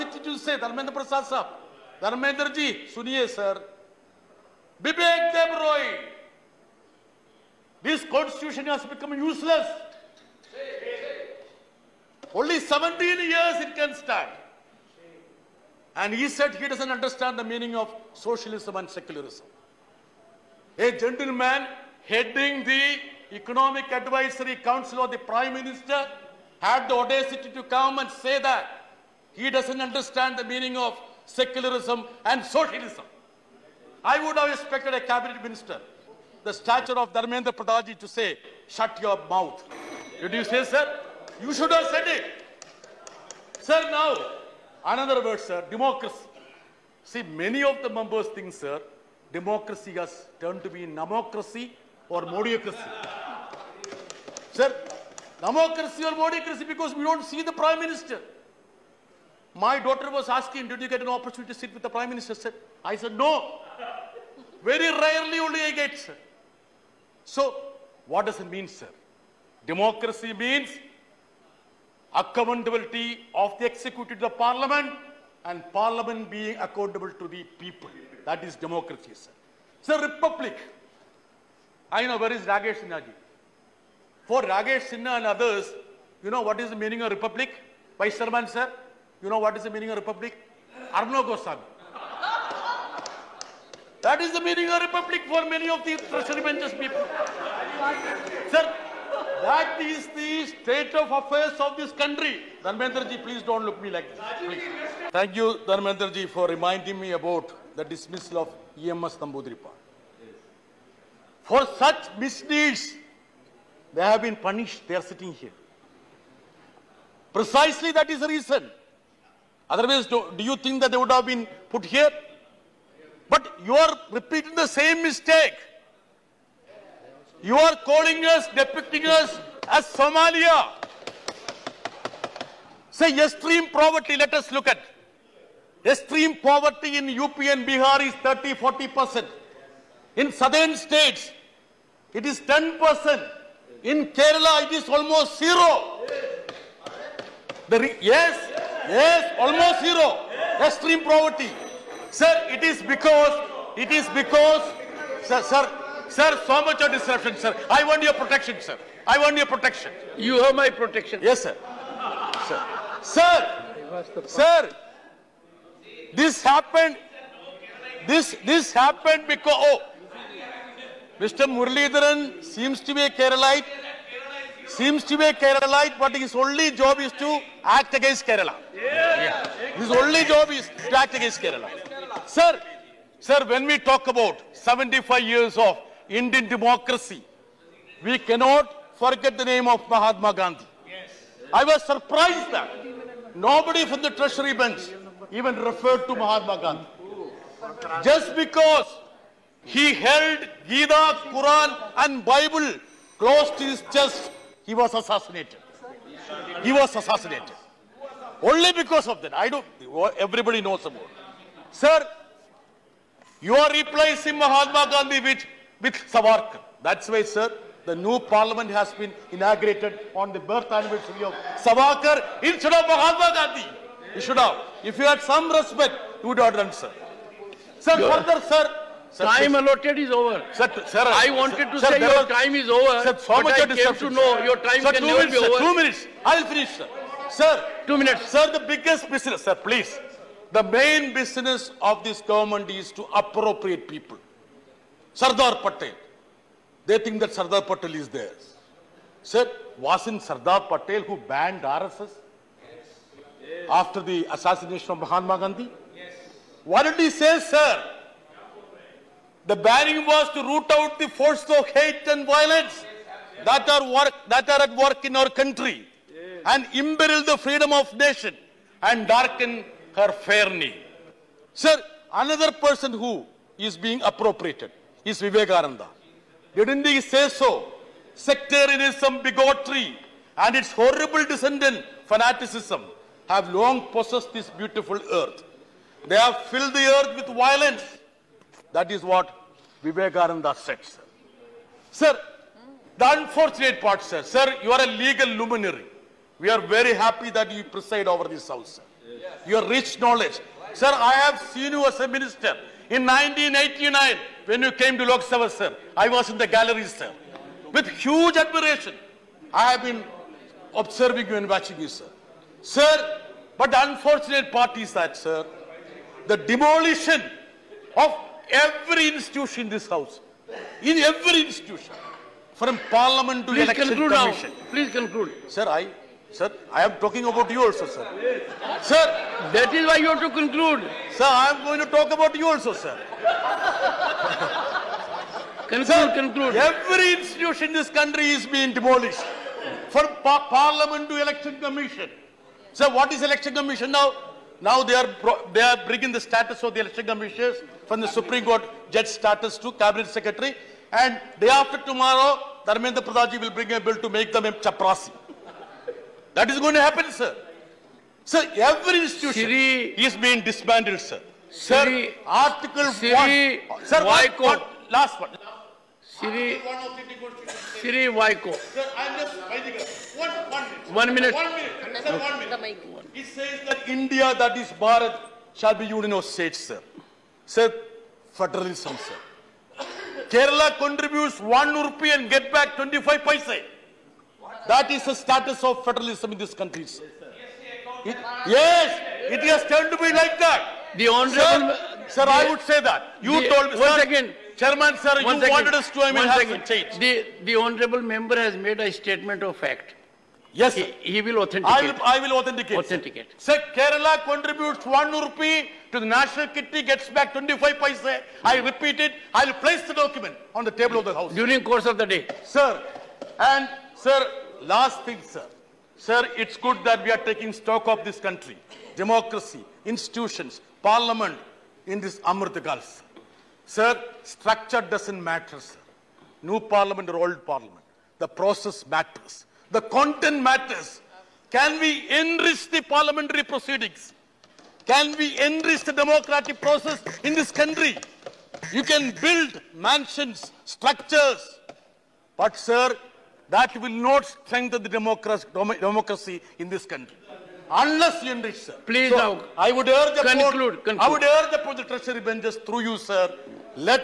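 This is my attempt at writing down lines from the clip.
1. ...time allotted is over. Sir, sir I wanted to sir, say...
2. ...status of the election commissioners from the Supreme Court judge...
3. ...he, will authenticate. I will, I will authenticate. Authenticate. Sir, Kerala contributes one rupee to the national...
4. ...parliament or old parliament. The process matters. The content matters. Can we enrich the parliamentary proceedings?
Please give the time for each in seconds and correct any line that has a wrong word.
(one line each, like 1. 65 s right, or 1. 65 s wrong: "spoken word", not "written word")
1. 229 s right
2. 346 s right
3. 400 s right
4. 426 s right.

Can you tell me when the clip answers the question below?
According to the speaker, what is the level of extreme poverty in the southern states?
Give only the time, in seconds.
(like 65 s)
142 s.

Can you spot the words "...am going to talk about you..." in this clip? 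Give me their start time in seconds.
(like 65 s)
331 s.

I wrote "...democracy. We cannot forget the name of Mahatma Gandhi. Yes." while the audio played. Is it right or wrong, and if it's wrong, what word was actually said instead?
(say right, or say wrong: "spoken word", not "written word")
right.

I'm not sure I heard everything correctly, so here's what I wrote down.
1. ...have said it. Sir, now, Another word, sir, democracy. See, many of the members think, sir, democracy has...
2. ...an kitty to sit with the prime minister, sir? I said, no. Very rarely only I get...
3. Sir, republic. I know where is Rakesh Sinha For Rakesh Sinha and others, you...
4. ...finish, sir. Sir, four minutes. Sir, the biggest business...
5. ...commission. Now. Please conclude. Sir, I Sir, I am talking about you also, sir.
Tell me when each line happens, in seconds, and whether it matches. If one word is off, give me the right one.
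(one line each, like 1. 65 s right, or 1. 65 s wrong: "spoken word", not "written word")
1. 41 s right
2. 61 s wrong: "opportunity", not "kitty"
3. 79 s right
4. 236 s wrong: "two", not "four"
5. 324 s right.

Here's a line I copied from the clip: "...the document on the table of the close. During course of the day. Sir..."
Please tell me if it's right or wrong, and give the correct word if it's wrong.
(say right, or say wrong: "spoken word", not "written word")
wrong: "house", not "close".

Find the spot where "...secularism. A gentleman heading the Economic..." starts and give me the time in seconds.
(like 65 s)
18 s.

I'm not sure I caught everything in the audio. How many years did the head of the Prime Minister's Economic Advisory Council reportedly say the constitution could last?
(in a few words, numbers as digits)
17.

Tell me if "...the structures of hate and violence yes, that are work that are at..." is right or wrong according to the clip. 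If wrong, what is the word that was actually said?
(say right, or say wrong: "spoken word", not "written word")
wrong: "forces", not "structures".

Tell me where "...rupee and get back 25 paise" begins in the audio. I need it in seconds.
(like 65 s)
381 s.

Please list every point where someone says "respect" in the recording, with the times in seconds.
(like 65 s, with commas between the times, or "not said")
225 s.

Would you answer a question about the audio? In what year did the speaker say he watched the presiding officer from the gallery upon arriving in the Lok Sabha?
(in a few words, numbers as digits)
1989.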